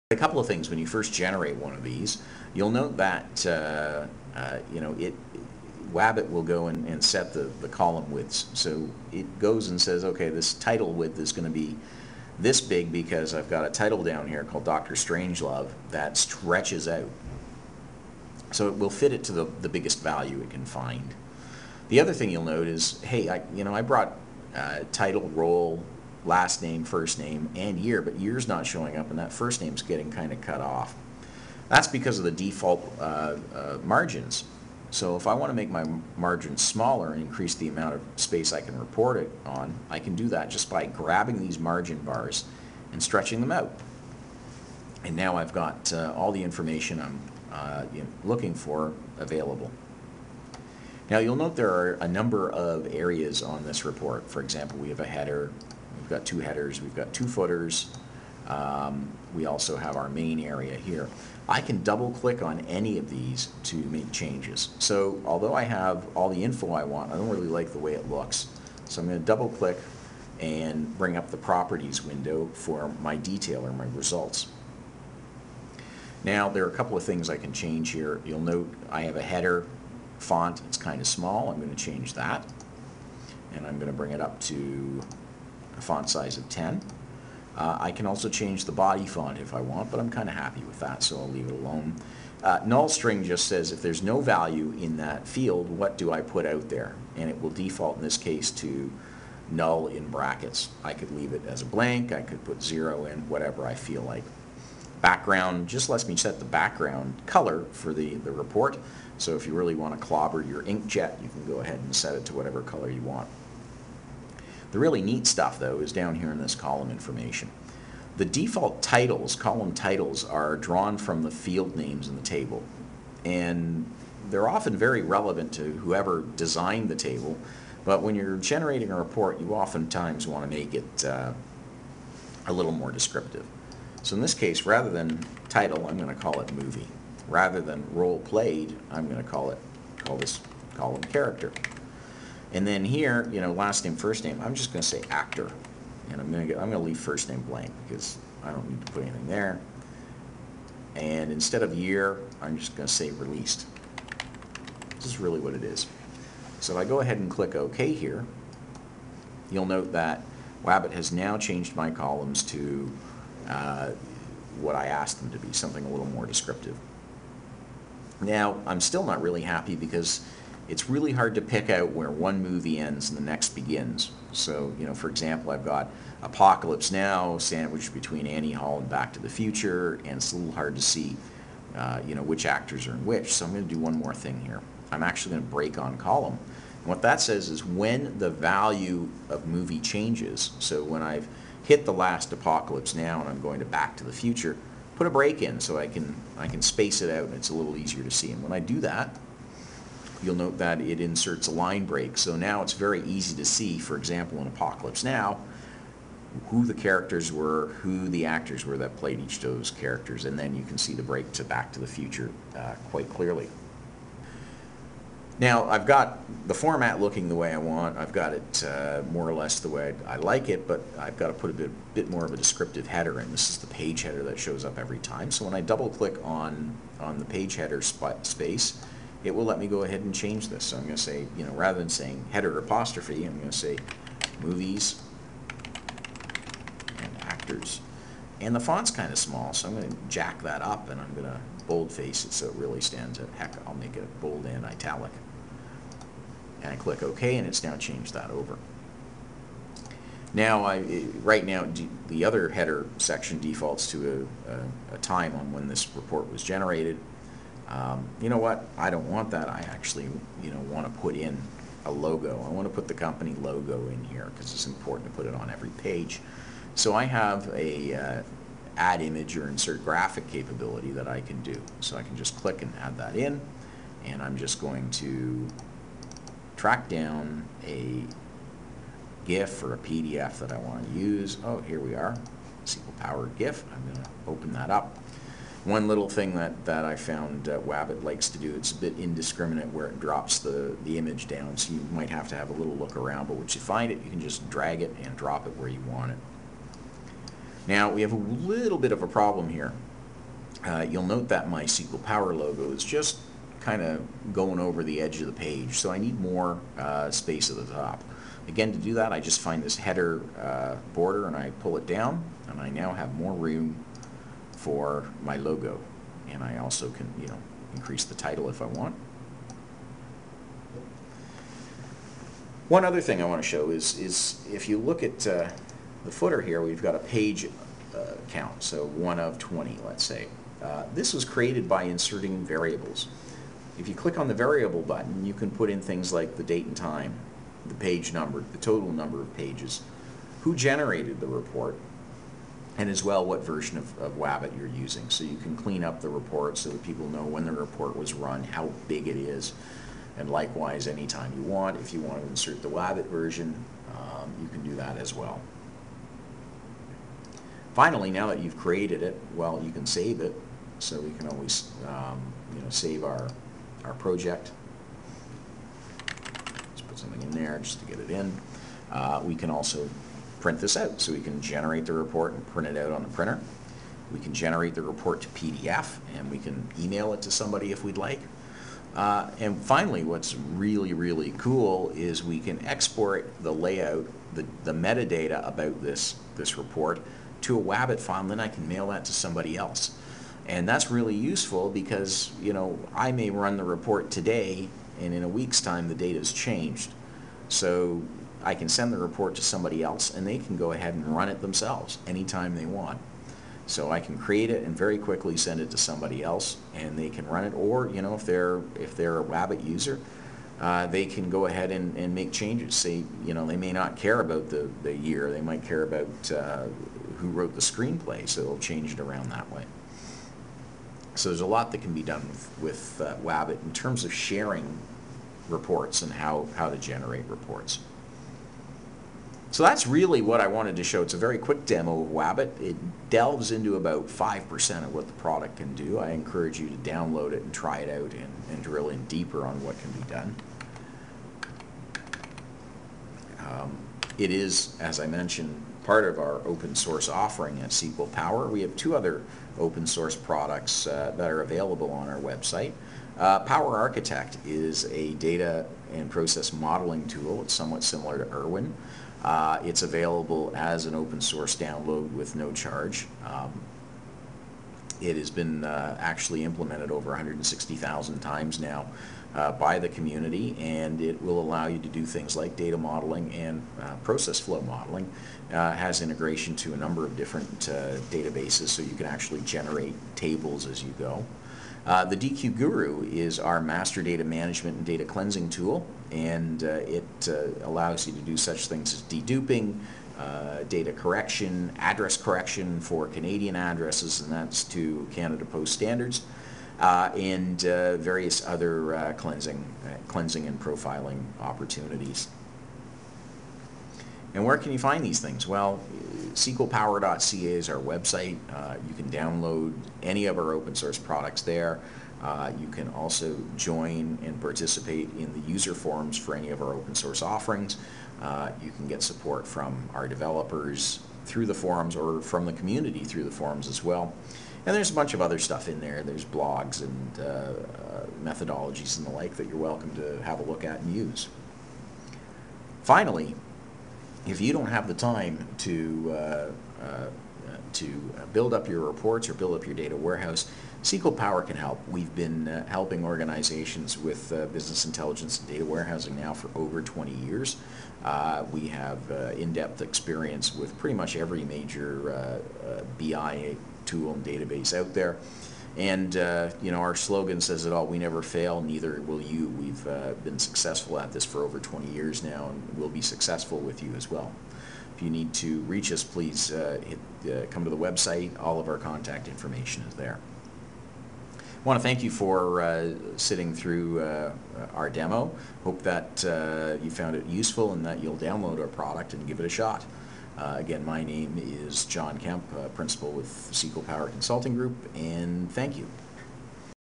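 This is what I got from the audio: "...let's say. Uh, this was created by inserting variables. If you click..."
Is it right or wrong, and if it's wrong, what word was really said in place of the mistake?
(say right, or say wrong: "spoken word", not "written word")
right.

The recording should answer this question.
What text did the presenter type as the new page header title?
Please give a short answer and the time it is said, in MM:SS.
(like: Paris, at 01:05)
movies and actors, at 03:54.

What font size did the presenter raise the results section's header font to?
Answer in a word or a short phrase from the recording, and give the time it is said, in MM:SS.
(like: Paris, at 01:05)
10, at 01:26.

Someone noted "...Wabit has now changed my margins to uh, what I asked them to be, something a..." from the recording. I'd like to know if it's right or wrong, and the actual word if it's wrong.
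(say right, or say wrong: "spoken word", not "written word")
wrong: "columns", not "margins".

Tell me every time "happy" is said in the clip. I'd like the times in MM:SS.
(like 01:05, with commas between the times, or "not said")
01:30, 02:49.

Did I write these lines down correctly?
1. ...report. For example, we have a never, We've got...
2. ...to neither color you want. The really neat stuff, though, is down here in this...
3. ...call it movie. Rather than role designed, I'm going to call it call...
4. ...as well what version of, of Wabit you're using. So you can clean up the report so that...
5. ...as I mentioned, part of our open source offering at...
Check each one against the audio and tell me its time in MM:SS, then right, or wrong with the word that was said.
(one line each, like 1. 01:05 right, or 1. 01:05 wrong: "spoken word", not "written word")
1. 00:53 wrong: "header", not "never"
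2. 01:52 wrong: "whatever", not "neither"
3. 02:16 wrong: "played", not "designed"
4. 05:42 right
5. 07:24 right.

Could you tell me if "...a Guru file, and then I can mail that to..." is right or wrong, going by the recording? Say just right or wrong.
wrong.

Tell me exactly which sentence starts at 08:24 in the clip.
And where can you find these things?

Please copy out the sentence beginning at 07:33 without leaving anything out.
Uh, Power Architect is a data and process modeling tool.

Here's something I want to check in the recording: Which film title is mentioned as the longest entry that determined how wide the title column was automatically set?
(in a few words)
Doctor Strangelove.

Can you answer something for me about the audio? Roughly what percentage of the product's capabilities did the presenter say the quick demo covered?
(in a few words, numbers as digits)
5%.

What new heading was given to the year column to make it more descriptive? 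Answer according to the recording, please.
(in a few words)
released.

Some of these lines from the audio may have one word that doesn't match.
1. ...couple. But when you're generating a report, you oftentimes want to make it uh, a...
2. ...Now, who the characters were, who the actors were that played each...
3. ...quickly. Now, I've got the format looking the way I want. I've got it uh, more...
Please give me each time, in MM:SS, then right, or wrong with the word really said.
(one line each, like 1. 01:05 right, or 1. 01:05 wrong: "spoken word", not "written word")
1. 02:06 wrong: "table", not "couple"
2. 03:25 right
3. 03:33 wrong: "clearly", not "quickly".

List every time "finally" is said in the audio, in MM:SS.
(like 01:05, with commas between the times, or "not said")
05:57, 06:19, 08:52.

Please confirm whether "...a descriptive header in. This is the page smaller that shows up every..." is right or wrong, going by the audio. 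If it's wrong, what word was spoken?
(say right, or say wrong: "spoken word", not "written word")
wrong: "header", not "smaller".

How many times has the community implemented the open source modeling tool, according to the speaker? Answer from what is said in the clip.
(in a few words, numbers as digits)
160,000.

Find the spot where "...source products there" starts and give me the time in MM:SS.
08:30.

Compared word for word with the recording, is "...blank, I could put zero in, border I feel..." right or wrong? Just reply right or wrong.
wrong.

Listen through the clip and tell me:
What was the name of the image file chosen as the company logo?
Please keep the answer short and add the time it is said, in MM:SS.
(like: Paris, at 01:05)
SQL Power GIF, at 04:42.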